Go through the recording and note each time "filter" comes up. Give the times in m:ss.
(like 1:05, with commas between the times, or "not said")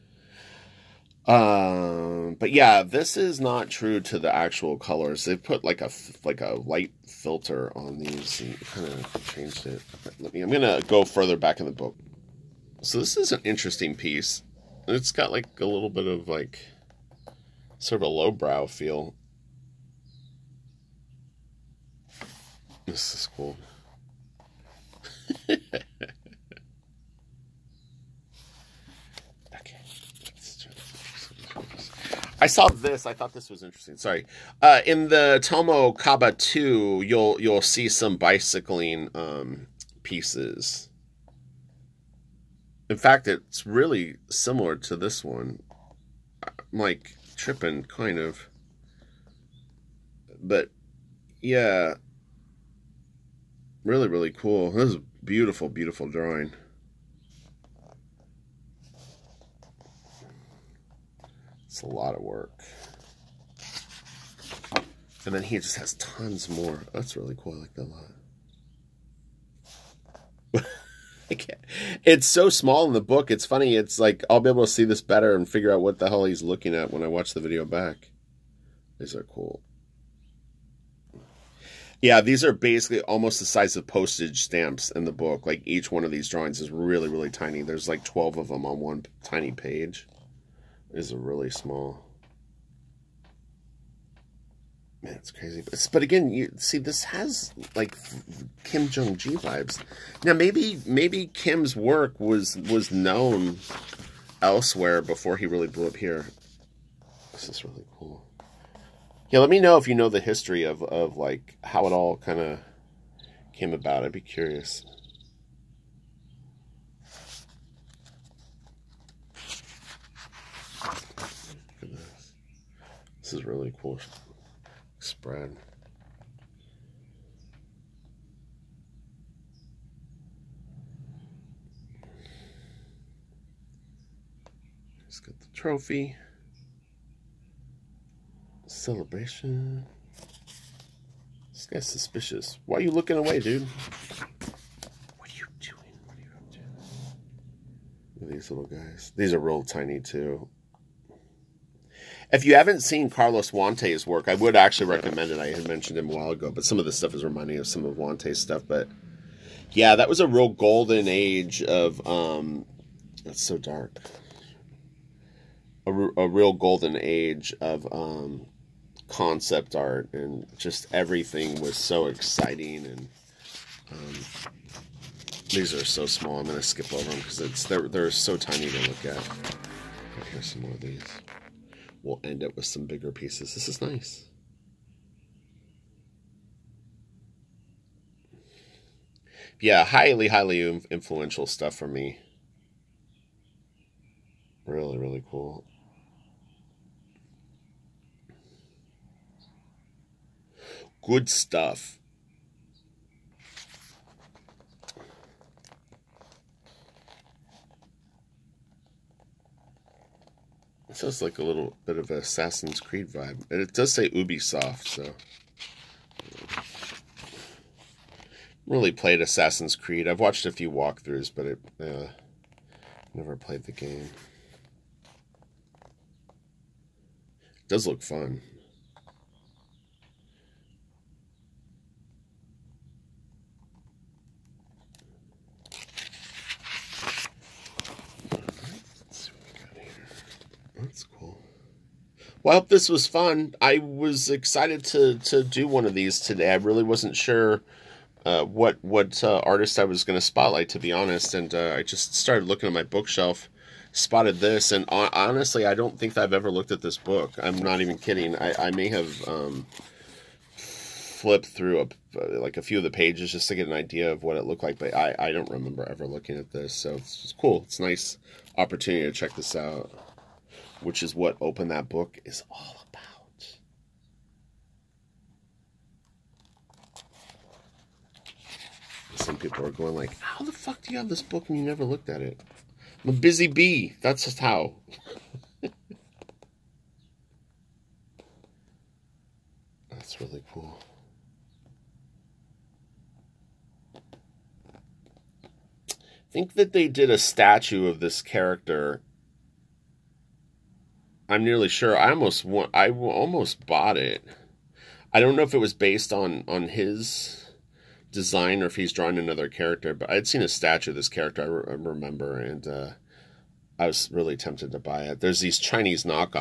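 0:07.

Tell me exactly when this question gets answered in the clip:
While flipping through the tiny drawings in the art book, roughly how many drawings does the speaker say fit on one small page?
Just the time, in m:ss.
1:28.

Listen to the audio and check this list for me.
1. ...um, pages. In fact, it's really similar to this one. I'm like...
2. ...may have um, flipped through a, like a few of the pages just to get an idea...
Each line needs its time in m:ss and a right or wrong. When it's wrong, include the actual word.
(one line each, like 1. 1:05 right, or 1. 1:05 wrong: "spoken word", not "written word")
1. 0:39 wrong: "pieces", not "pages"
2. 4:18 right.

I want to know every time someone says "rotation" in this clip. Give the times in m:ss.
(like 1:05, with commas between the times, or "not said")
not said.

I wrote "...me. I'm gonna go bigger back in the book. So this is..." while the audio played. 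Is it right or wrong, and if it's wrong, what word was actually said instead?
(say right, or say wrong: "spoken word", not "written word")
wrong: "further", not "bigger".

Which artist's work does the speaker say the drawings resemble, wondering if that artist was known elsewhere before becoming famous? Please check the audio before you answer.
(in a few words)
Kim Jung Gi.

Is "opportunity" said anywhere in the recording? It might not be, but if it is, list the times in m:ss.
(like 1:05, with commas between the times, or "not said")
4:28.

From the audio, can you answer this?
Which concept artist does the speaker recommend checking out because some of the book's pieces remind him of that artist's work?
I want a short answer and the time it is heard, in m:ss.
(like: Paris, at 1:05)
Carlos Huante, at 2:33.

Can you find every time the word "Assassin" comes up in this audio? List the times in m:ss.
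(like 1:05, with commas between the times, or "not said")
3:32, 3:39.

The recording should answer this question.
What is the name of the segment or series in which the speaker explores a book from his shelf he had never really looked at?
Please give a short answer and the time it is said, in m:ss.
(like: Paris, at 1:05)
Open That Book, at 4:31.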